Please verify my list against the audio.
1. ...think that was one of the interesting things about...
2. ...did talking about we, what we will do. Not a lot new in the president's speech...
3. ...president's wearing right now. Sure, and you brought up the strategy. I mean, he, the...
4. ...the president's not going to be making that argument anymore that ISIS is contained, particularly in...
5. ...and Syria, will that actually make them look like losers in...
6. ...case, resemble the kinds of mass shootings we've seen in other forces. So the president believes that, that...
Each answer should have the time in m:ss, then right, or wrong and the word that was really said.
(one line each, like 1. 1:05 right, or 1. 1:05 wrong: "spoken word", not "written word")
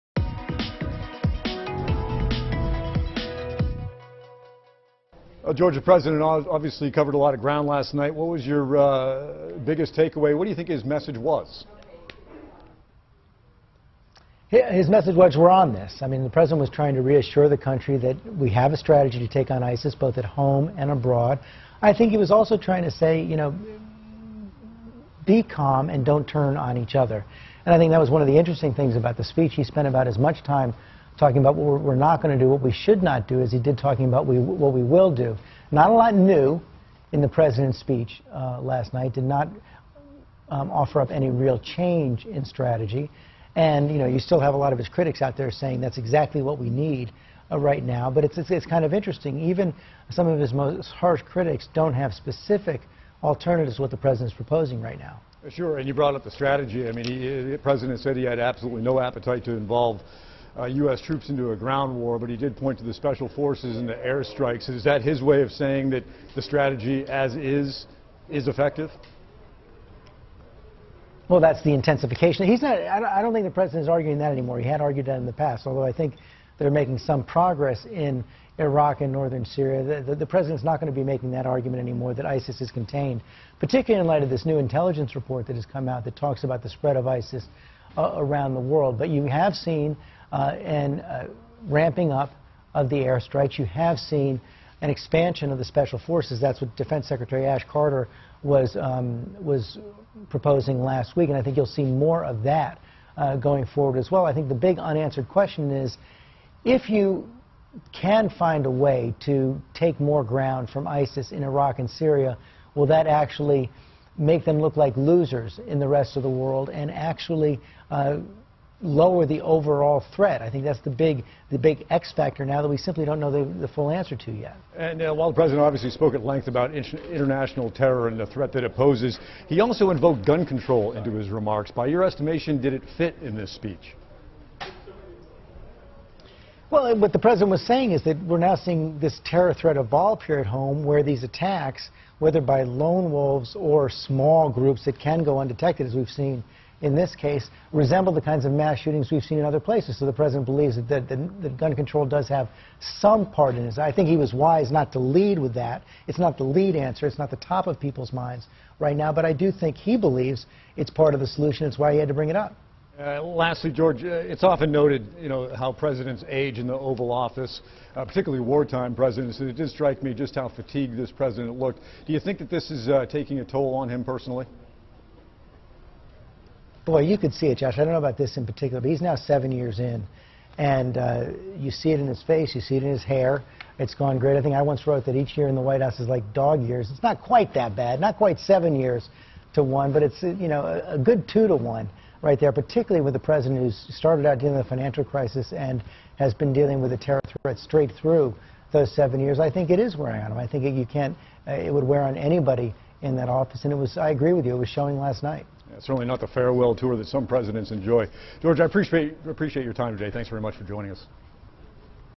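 1. 0:27 right
2. 0:33 right
3. 0:53 wrong: "proposing", not "wearing"
4. 1:20 right
5. 1:51 right
6. 2:27 wrong: "places", not "forces".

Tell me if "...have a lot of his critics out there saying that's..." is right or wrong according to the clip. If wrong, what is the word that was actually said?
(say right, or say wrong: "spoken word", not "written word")
right.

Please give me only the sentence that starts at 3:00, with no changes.
And uh, you see it in his face, you see it in his hair.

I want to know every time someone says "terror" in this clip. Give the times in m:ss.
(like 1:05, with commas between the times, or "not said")
2:07, 2:19, 3:16.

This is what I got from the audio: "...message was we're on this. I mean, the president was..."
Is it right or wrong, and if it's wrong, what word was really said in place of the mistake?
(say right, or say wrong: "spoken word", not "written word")
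right.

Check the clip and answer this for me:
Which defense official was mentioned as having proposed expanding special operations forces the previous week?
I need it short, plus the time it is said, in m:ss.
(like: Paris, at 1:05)
Ash Carter, at 1:37.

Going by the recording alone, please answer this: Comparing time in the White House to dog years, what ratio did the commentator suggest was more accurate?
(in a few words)
2 to 1.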